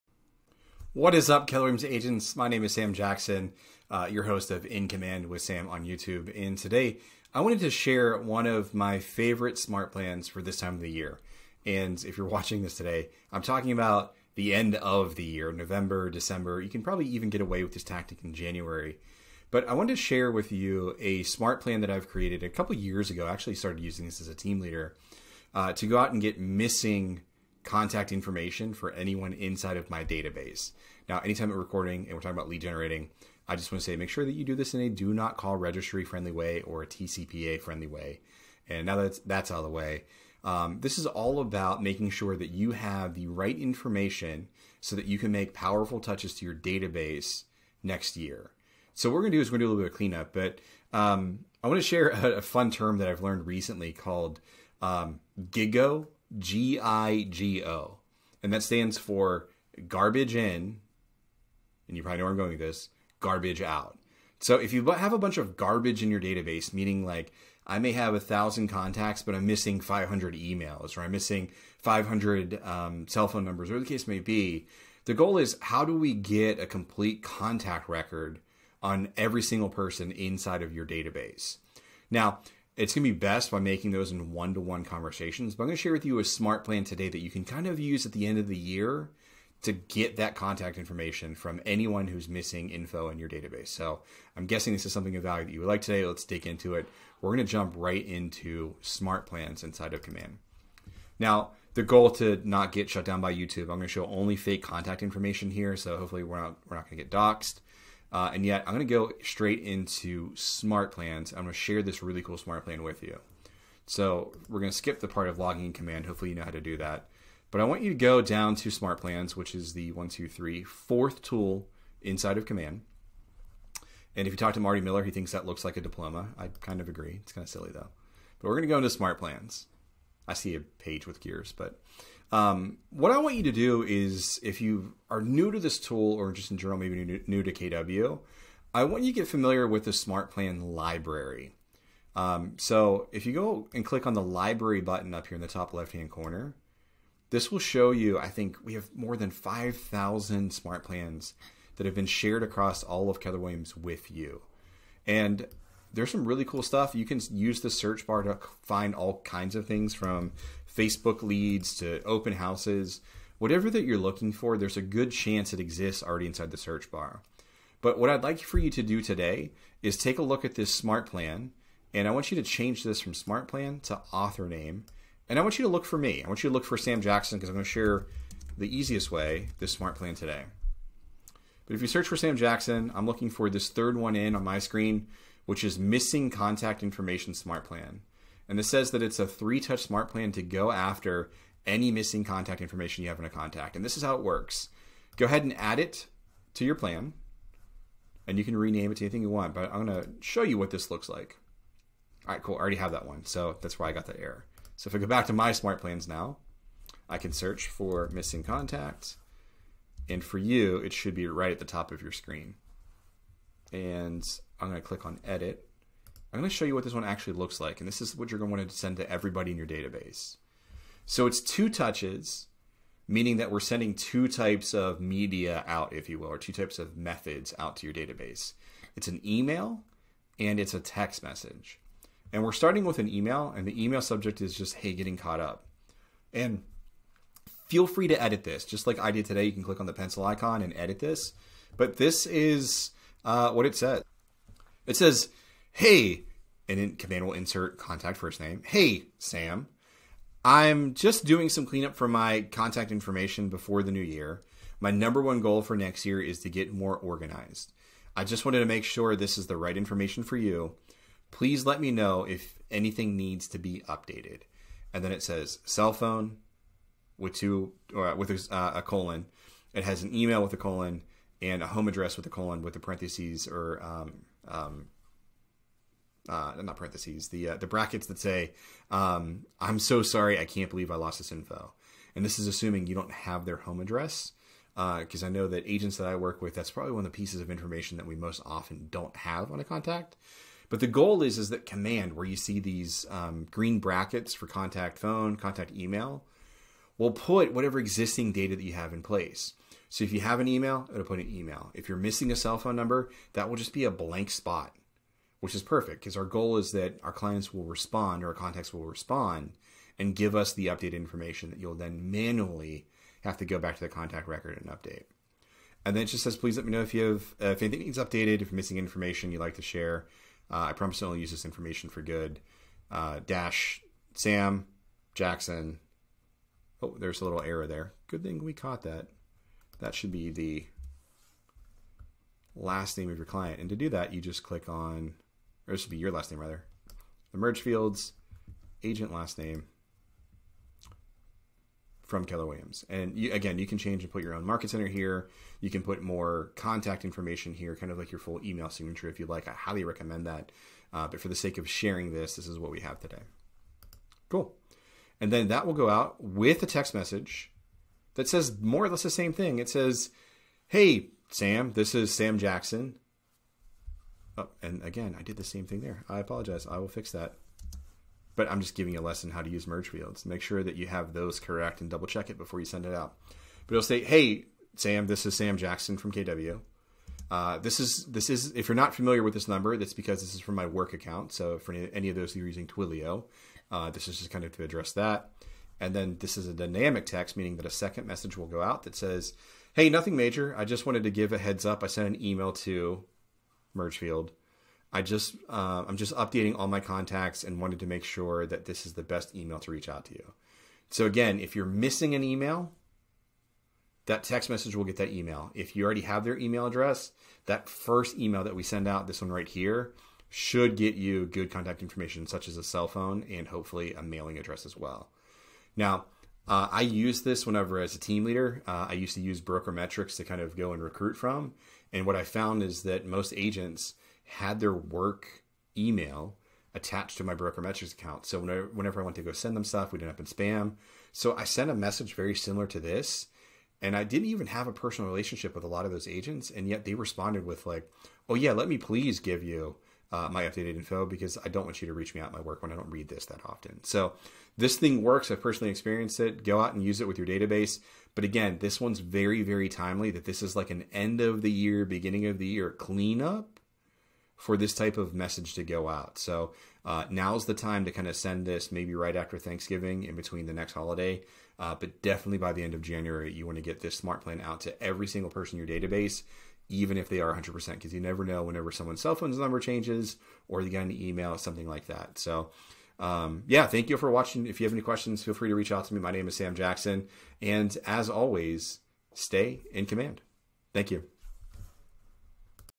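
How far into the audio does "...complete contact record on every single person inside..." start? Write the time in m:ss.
1:16.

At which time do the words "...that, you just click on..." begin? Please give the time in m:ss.
5:33.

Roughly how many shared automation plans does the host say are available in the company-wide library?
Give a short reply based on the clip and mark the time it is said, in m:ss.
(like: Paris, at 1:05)
5,000, at 2:29.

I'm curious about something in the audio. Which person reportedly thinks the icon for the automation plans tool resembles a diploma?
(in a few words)
Marty Miller.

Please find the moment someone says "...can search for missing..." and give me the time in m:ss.
3:27.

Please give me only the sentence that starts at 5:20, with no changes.
Uh, I promise to only use this information for good.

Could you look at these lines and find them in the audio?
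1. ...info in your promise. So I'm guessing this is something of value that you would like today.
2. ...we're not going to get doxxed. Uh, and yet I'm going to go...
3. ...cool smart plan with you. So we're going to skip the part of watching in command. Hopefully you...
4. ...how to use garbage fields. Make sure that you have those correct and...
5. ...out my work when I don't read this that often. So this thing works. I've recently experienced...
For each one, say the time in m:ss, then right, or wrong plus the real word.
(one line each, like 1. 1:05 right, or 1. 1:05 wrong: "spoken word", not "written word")
1. 1:32 wrong: "database", not "promise"
2. 1:46 right
3. 1:52 wrong: "logging", not "watching"
4. 6:09 wrong: "merge", not "garbage"
5. 7:22 wrong: "personally", not "recently".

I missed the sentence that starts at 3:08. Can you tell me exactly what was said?
And this says that it's a three touch smart plan to go after any missing contact information you have in a contact.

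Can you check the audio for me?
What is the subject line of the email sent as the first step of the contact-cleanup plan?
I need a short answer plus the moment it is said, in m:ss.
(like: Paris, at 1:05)
Hey, getting caught up, at 3:54.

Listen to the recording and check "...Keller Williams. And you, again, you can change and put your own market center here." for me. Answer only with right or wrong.
right.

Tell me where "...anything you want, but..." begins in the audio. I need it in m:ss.
3:19.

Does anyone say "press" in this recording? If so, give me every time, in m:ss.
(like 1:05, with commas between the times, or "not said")
not said.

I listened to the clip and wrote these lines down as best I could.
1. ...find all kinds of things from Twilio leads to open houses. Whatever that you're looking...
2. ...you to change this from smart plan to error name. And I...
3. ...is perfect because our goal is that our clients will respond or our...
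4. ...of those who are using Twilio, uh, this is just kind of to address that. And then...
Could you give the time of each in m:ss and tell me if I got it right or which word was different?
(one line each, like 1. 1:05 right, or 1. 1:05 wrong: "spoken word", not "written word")
1. 2:38 wrong: "Facebook", not "Twilio"
2. 2:52 wrong: "author", not "error"
3. 5:05 right
4. 6:22 right.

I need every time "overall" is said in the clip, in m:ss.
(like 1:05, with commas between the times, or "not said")
not said.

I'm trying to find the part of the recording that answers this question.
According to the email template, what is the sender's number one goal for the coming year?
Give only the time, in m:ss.
4:16.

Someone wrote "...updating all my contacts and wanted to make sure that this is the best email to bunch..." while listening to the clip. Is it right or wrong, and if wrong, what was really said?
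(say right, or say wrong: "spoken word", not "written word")
wrong: "reach", not "bunch".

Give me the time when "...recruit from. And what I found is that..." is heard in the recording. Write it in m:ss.
7:00.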